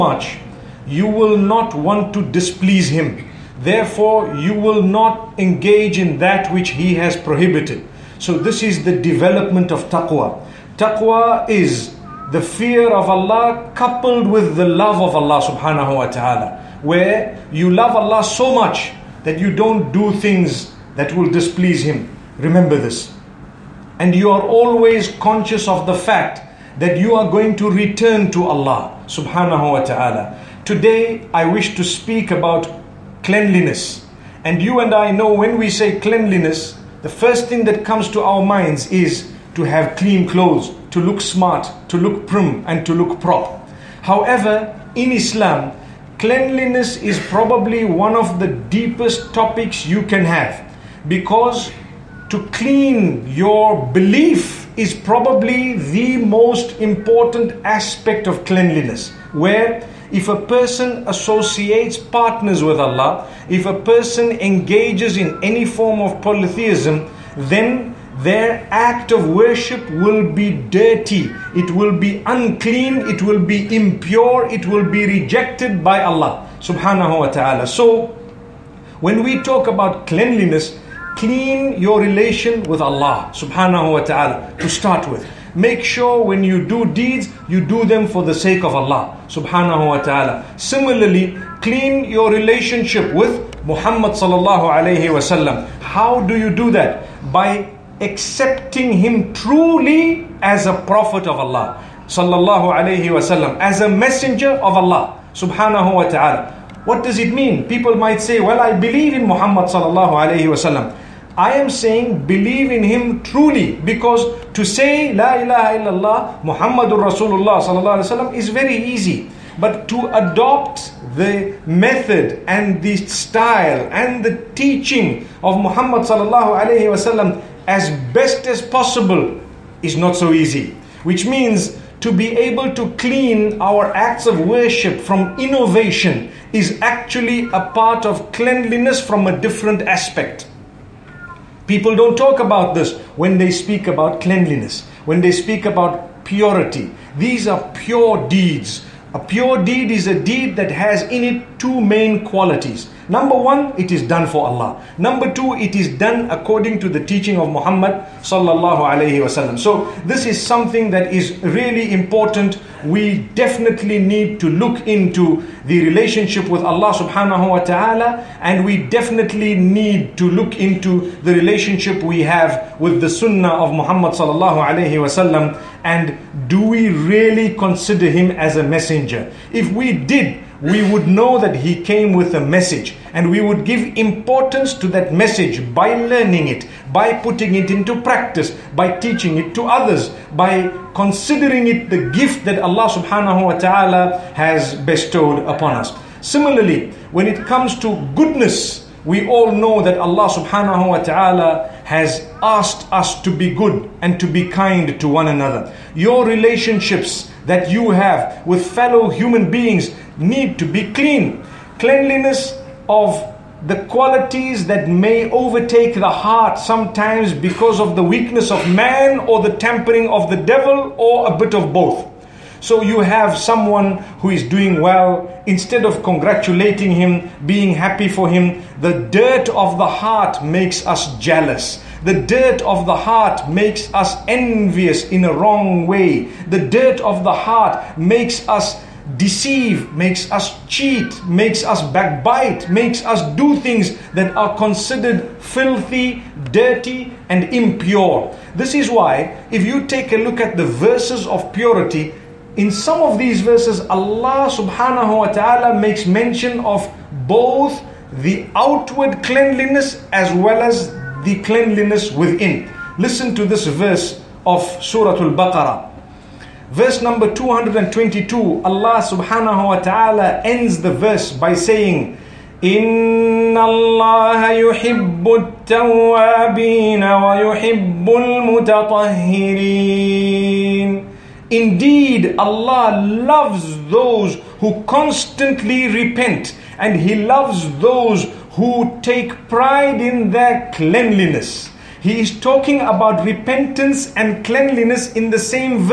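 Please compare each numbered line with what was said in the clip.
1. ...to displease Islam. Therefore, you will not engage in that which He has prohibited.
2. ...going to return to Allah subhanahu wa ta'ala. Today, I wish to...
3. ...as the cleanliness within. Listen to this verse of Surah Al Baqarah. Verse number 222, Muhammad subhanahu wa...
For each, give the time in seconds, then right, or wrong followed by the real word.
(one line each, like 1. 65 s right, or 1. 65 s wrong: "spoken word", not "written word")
1. 2 s wrong: "Him", not "Islam"
2. 27 s right
3. 260 s wrong: "Allah", not "Muhammad".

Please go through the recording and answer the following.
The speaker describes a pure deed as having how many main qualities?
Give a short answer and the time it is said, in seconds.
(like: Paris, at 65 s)
2, at 151 s.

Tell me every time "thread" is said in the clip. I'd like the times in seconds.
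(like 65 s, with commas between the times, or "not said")
not said.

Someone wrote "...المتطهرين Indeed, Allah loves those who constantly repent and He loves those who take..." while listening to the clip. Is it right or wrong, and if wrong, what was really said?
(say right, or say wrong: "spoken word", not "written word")
right.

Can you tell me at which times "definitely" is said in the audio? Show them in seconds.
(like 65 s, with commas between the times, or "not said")
163 s, 168 s.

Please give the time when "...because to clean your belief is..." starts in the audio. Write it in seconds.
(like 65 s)
51 s.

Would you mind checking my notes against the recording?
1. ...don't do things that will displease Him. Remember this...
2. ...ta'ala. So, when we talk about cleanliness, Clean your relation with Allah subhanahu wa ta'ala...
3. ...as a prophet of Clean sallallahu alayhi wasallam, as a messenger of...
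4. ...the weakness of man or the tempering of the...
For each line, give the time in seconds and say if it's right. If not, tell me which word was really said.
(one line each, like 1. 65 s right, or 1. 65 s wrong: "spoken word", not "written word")
1. 19 s right
2. 77 s right
3. 100 s wrong: "Allah", not "Clean"
4. 217 s right.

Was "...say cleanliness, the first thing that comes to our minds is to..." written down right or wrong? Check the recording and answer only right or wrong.
right.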